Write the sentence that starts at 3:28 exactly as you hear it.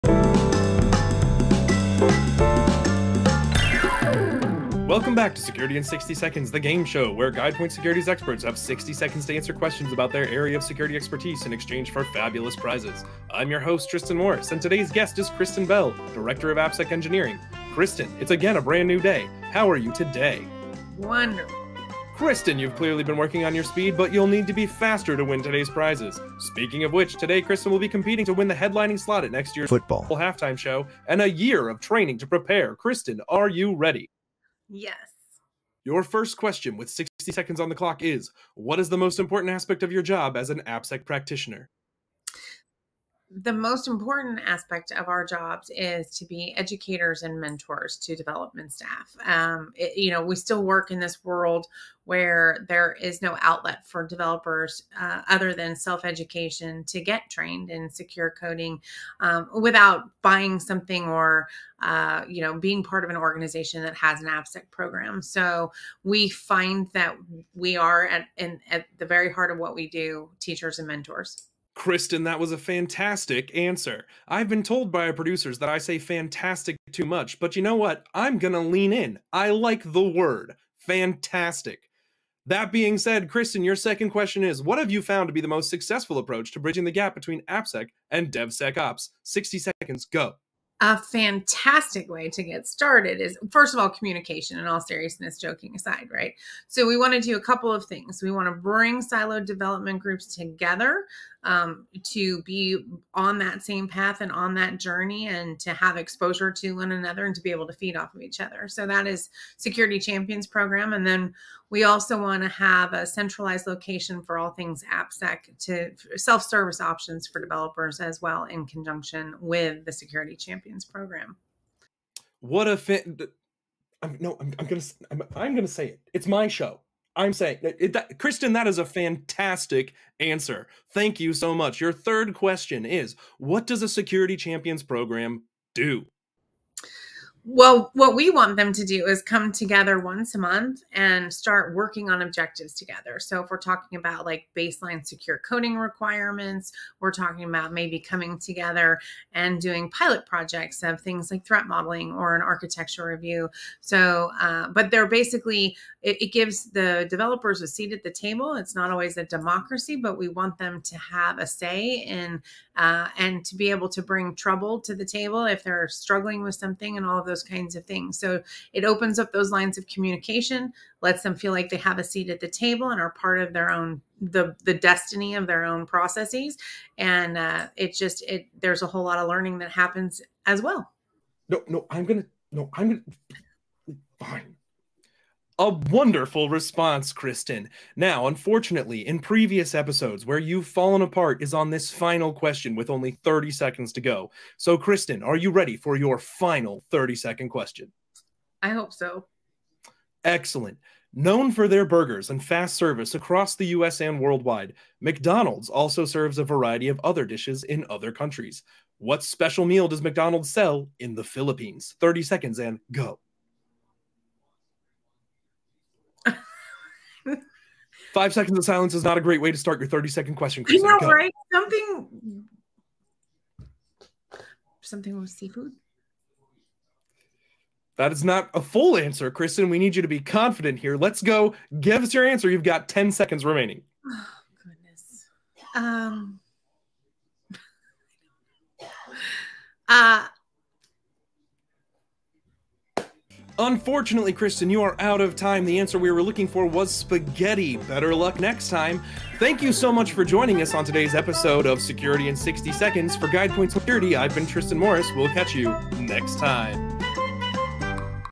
What special meal does McDonald's sell in the Philippines?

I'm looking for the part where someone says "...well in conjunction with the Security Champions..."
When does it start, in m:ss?
1:58.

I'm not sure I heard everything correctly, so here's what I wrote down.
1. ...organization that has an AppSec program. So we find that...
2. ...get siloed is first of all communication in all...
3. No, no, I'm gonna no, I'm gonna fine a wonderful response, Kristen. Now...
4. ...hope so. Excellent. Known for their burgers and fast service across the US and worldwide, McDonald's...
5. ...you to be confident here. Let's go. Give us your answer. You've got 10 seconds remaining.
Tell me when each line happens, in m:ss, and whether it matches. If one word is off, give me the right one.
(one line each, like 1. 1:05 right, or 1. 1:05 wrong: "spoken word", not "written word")
1. 1:03 right
2. 1:32 wrong: "started", not "siloed"
3. 3:01 right
4. 3:18 right
5. 3:49 right.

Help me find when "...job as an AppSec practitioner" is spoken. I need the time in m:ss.
0:40.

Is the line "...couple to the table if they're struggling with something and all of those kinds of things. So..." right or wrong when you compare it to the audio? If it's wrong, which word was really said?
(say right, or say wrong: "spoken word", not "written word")
wrong: "trouble", not "couple".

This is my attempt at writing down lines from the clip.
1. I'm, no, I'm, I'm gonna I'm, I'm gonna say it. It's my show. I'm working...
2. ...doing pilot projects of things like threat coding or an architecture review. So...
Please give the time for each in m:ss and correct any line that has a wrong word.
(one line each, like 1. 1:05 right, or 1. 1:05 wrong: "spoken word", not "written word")
1. 2:04 wrong: "saying", not "working"
2. 2:29 wrong: "modeling", not "coding".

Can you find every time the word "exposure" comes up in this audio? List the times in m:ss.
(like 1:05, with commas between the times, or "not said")
1:45.